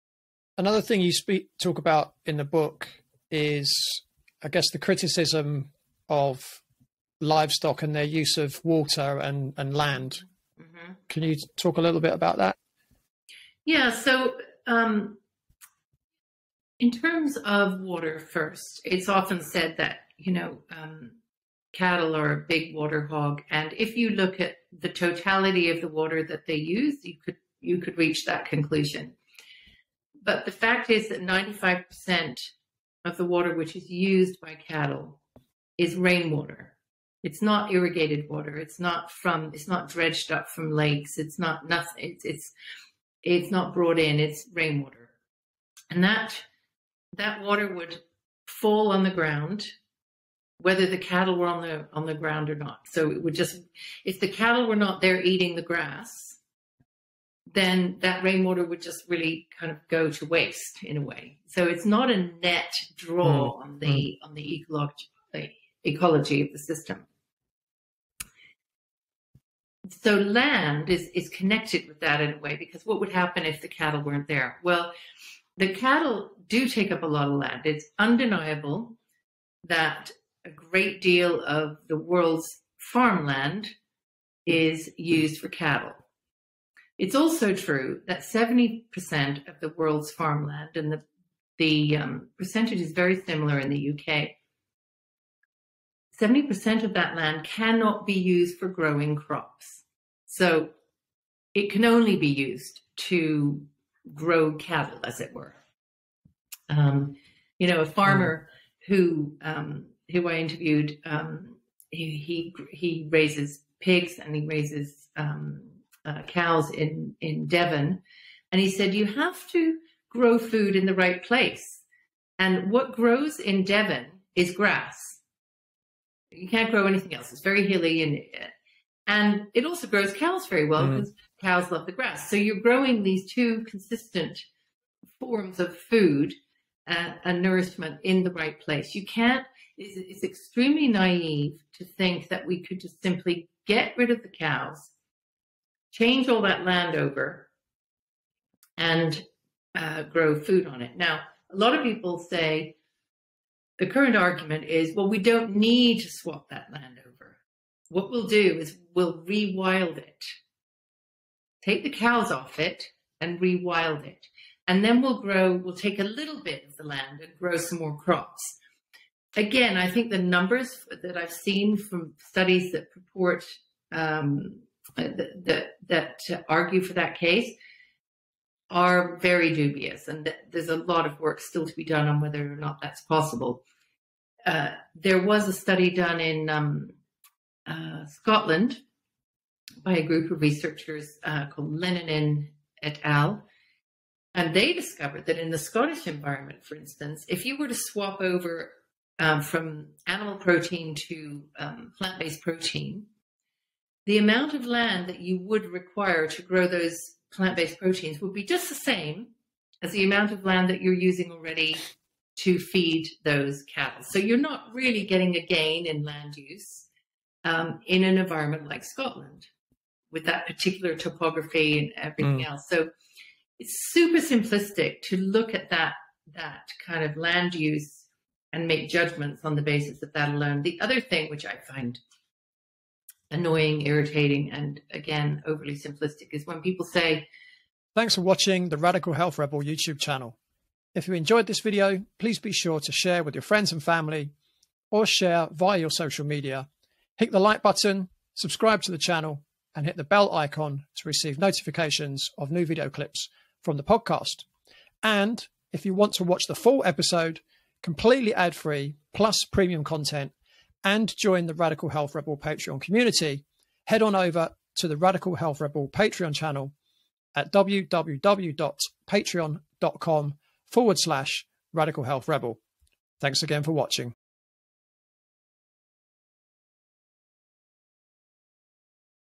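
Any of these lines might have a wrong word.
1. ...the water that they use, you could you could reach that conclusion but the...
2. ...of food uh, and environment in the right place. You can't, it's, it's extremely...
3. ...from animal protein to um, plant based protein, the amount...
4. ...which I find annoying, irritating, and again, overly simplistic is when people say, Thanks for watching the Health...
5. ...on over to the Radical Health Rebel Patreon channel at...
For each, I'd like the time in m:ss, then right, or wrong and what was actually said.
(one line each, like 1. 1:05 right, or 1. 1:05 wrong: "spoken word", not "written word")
1. 0:25 right
2. 2:15 wrong: "nourishment", not "environment"
3. 3:19 right
4. 3:51 wrong: "Radical", not "Health"
5. 4:24 right.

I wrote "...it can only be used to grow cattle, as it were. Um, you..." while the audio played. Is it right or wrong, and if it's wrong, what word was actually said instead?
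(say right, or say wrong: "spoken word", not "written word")
right.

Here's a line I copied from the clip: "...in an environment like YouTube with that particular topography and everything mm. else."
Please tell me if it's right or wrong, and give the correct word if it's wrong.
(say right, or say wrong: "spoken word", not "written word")
wrong: "Scotland", not "YouTube".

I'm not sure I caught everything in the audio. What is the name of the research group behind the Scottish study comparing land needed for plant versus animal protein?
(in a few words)
Lennon et al.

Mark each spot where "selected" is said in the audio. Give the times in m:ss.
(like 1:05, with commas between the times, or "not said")
not said.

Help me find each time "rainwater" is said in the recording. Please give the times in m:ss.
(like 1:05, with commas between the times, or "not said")
0:35, 0:44, 0:58.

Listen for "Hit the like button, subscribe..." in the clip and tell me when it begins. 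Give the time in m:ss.
4:07.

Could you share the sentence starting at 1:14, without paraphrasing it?
Well, the cattle do take up a lot of land.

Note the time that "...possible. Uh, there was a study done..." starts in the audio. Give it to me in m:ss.
3:03.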